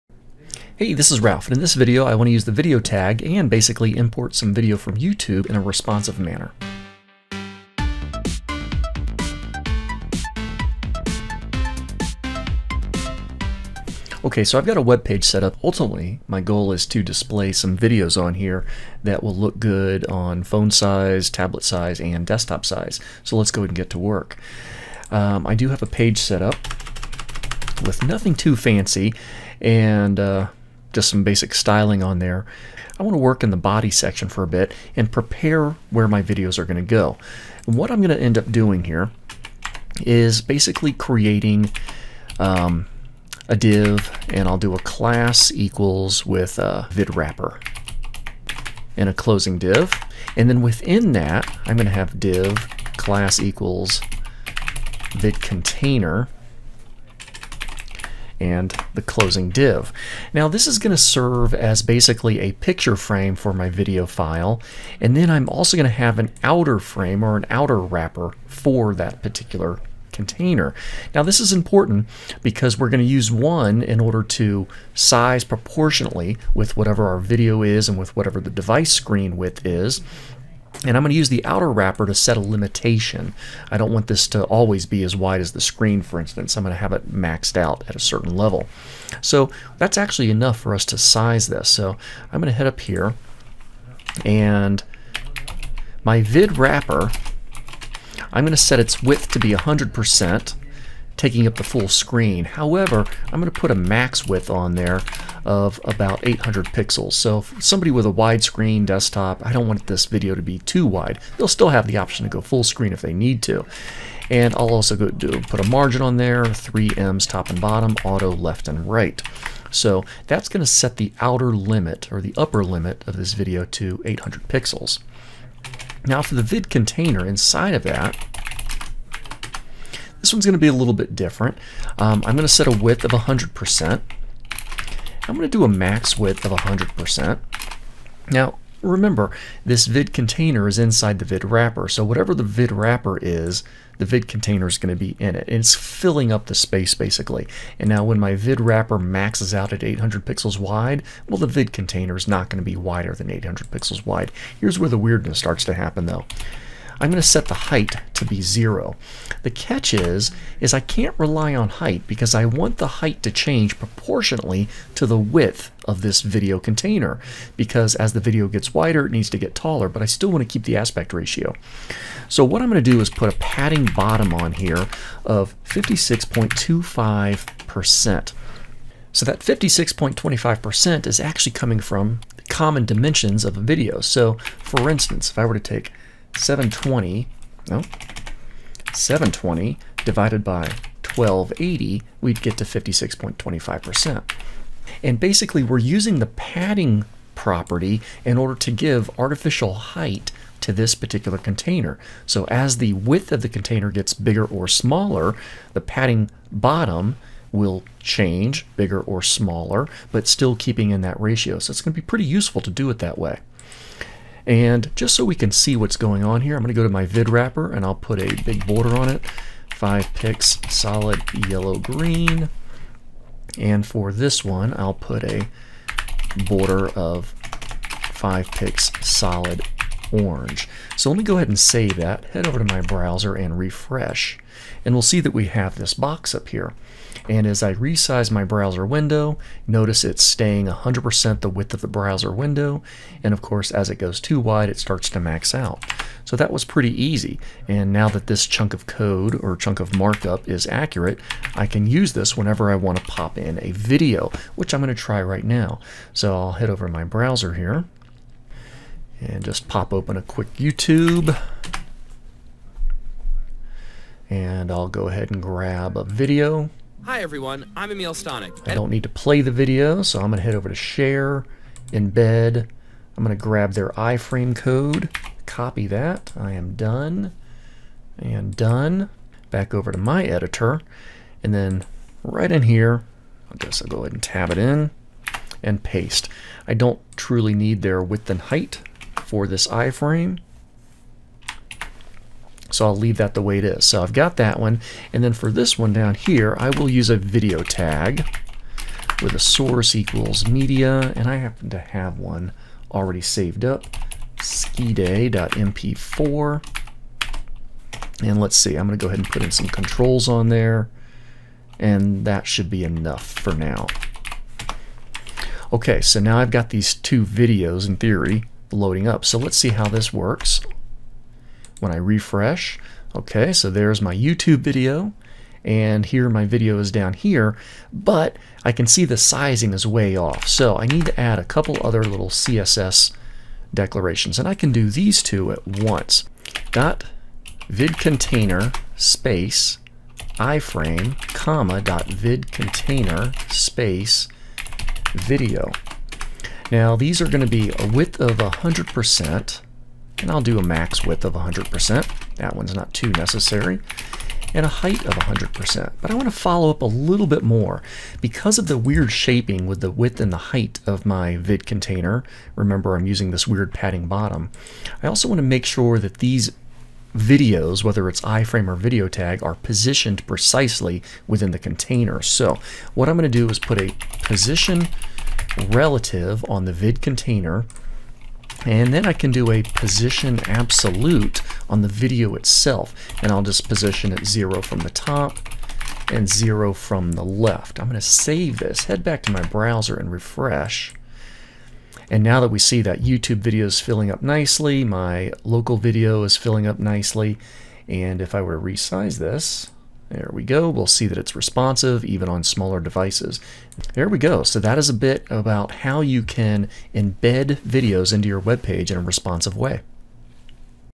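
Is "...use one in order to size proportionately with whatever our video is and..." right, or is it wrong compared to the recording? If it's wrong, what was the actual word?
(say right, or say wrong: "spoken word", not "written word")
right.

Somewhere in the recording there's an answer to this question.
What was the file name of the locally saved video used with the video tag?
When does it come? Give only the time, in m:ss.
5:04.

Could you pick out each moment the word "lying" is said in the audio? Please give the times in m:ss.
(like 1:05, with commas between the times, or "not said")
not said.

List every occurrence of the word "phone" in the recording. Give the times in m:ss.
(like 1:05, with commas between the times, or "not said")
0:20.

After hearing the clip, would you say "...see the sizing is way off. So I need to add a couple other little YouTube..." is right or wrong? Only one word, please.
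wrong.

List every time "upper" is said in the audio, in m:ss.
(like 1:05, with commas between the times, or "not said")
2:02.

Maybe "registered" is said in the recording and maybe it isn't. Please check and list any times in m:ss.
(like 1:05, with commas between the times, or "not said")
not said.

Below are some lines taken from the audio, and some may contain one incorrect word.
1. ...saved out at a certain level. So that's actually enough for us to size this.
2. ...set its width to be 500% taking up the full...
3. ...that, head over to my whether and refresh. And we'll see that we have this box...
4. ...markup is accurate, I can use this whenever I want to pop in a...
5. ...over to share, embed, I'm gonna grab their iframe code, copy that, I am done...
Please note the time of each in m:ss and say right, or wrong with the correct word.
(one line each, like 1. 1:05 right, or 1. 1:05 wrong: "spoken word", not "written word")
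1. 1:27 wrong: "maxed", not "saved"
2. 1:38 wrong: "100", not "500"
3. 3:51 wrong: "browser", not "whether"
4. 4:09 right
5. 4:30 right.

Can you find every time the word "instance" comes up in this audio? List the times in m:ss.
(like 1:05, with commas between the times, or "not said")
1:26, 3:04.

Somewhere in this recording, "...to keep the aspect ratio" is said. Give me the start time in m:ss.
2:50.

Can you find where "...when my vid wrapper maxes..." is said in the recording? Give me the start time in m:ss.
2:28.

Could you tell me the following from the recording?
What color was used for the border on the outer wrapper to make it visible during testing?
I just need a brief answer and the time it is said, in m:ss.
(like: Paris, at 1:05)
yellow green, at 3:41.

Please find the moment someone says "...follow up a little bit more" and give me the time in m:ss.
5:56.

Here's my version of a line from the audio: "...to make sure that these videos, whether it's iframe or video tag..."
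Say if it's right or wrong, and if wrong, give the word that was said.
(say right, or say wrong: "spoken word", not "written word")
right.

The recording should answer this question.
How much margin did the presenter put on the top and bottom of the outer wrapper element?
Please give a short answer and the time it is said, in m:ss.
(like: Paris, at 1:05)
3ems, at 1:56.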